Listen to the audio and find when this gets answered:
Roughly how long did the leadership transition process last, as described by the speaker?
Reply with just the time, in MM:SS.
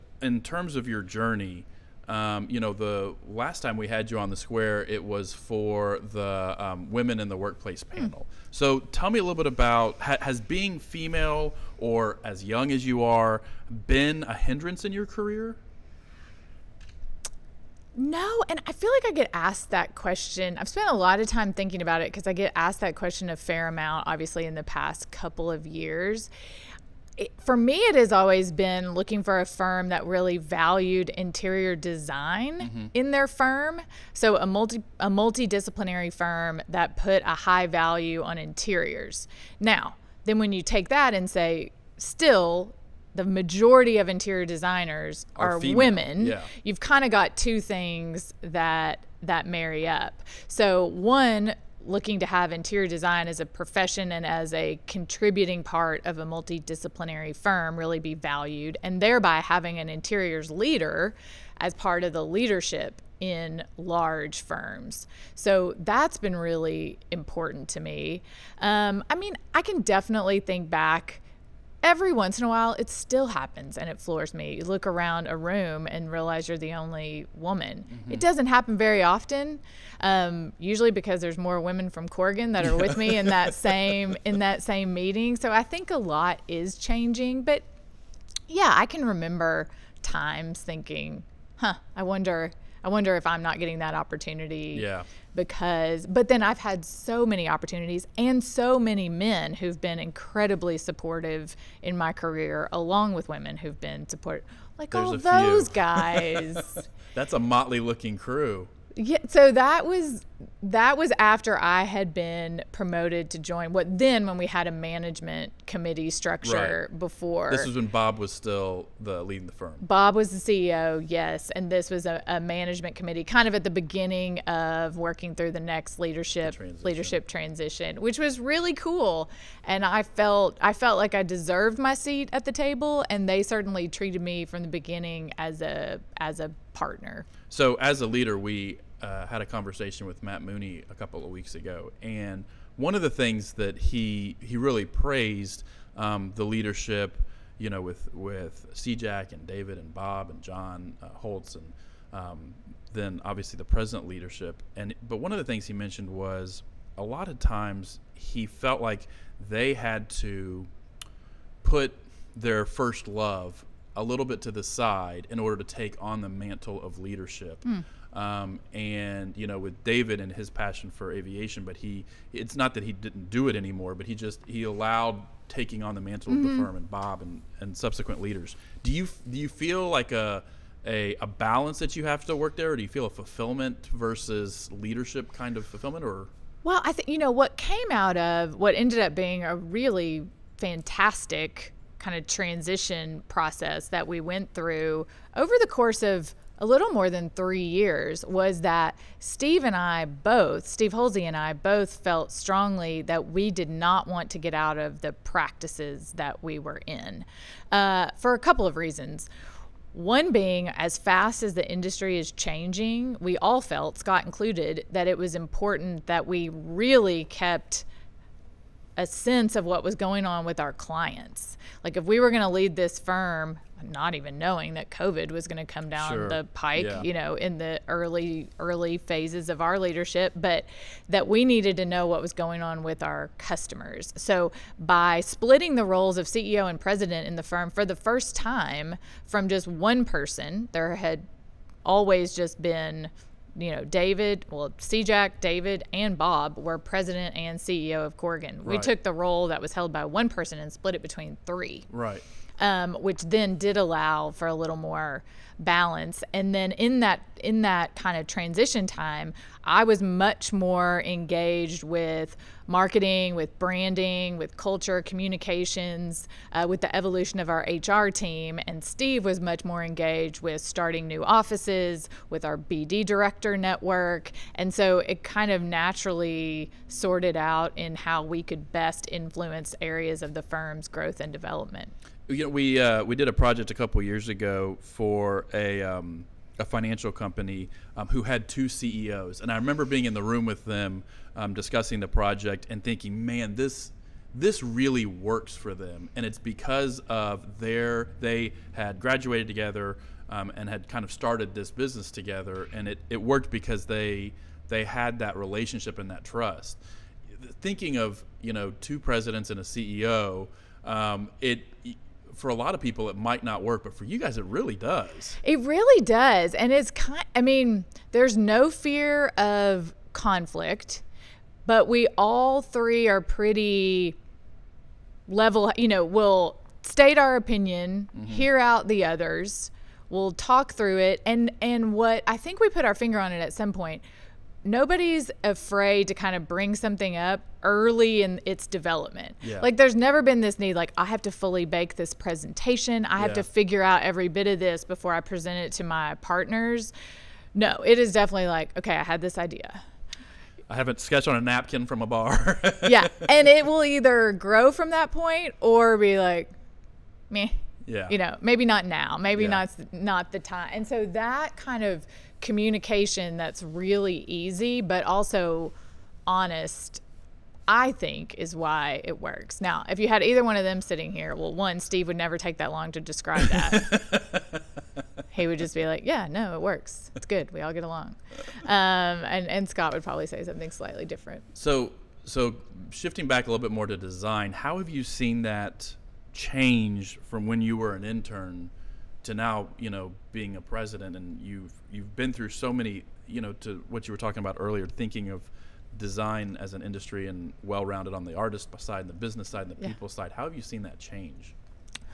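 03:16.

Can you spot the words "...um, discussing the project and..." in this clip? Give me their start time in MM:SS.
04:51.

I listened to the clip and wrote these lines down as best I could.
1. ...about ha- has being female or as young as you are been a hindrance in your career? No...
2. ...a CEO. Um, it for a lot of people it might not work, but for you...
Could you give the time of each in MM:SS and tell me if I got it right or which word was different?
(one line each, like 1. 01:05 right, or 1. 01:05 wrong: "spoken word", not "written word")
1. 00:09 right
2. 05:09 right.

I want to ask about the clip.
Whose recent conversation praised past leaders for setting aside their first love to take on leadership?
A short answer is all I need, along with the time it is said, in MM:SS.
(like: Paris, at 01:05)
Matt Mooney, at 02:20.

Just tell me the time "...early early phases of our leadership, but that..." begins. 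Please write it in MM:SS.
03:47.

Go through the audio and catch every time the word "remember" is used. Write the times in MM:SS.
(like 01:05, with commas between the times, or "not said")
01:29, 04:49.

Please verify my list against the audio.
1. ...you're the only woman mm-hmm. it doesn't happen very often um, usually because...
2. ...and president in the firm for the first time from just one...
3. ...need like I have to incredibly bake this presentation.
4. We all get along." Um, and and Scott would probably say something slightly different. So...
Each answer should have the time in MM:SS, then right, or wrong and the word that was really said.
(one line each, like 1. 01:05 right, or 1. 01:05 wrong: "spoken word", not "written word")
1. 01:16 right
2. 03:56 right
3. 05:40 wrong: "fully", not "incredibly"
4. 06:17 right.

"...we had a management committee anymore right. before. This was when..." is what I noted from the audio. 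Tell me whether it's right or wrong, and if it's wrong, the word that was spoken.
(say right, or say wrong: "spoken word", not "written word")
wrong: "structure", not "anymore".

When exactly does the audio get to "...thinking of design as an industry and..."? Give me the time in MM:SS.
06:34.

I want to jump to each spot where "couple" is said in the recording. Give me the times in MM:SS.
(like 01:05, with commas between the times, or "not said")
00:25, 02:20, 03:28, 04:43.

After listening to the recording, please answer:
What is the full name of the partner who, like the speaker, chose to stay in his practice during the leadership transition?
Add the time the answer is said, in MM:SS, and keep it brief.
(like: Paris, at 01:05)
Steve Holsey, at 03:20.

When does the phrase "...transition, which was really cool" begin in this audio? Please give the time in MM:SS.
02:07.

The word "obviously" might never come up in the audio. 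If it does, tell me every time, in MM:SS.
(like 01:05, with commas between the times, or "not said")
00:24, 02:33.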